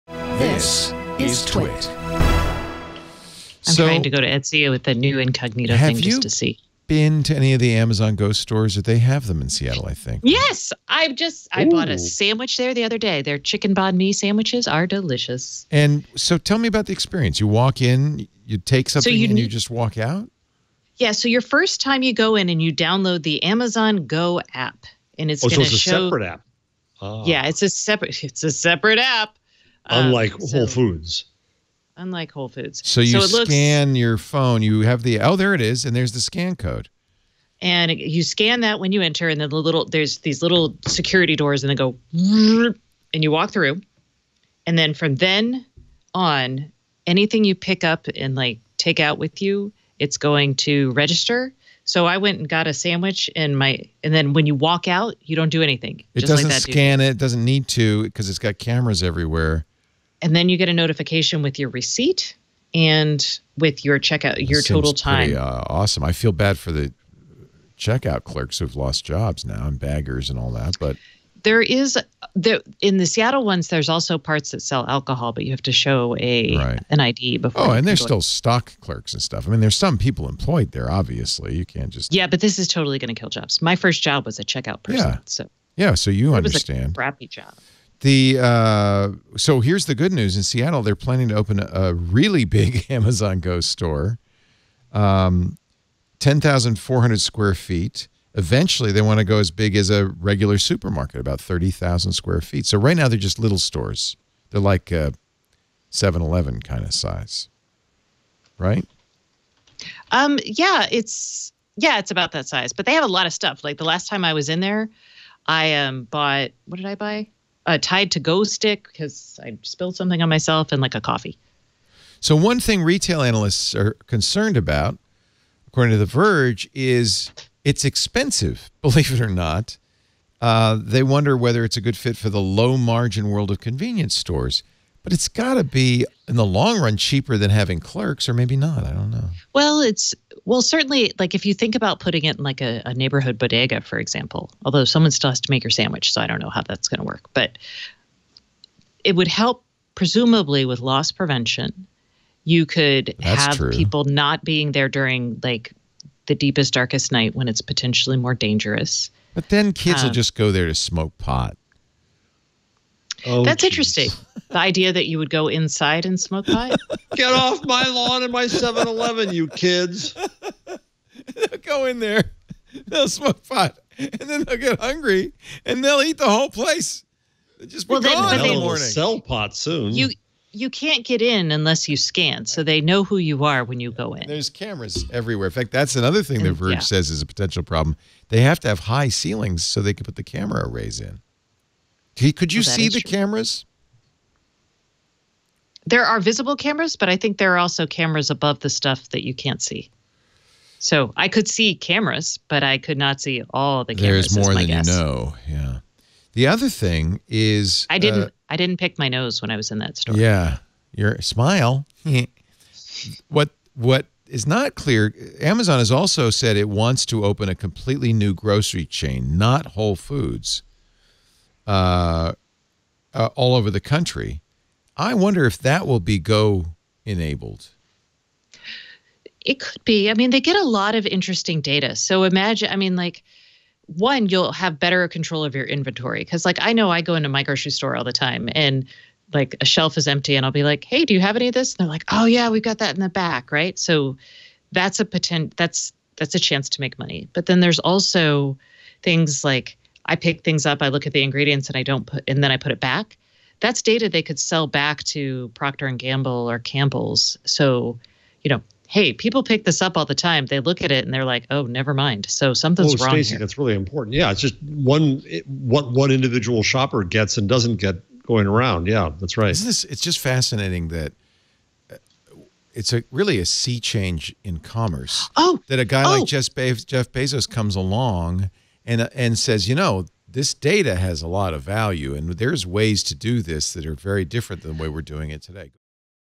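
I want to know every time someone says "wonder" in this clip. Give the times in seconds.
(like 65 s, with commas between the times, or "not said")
131 s, 225 s.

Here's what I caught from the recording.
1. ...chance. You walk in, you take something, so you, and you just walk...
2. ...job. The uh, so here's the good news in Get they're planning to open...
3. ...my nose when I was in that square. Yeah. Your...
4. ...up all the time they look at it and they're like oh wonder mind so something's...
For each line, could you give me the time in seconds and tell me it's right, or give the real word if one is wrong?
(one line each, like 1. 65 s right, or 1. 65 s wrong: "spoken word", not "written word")
1. 16 s wrong: "experience", not "chance"
2. 87 s wrong: "Seattle", not "Get"
3. 208 s wrong: "store", not "square"
4. 259 s wrong: "never", not "wonder".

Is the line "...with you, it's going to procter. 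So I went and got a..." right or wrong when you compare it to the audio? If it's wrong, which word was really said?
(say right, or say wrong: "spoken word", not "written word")
wrong: "register", not "procter".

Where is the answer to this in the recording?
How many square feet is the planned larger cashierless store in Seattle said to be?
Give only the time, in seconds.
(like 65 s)
96 s.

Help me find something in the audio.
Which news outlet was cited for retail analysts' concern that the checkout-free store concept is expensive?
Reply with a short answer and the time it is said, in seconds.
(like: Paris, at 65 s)
The Verge, at 125 s.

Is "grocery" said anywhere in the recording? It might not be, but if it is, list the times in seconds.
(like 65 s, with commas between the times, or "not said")
218 s, 237 s.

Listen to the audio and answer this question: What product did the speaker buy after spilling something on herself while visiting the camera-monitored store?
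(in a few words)
Tide to Go stick.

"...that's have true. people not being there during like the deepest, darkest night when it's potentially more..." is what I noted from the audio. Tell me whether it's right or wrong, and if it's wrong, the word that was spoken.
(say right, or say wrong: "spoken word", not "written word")
right.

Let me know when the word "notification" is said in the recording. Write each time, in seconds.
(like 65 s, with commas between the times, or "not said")
60 s.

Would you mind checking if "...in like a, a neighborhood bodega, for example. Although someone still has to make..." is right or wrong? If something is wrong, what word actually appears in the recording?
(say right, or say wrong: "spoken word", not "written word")
right.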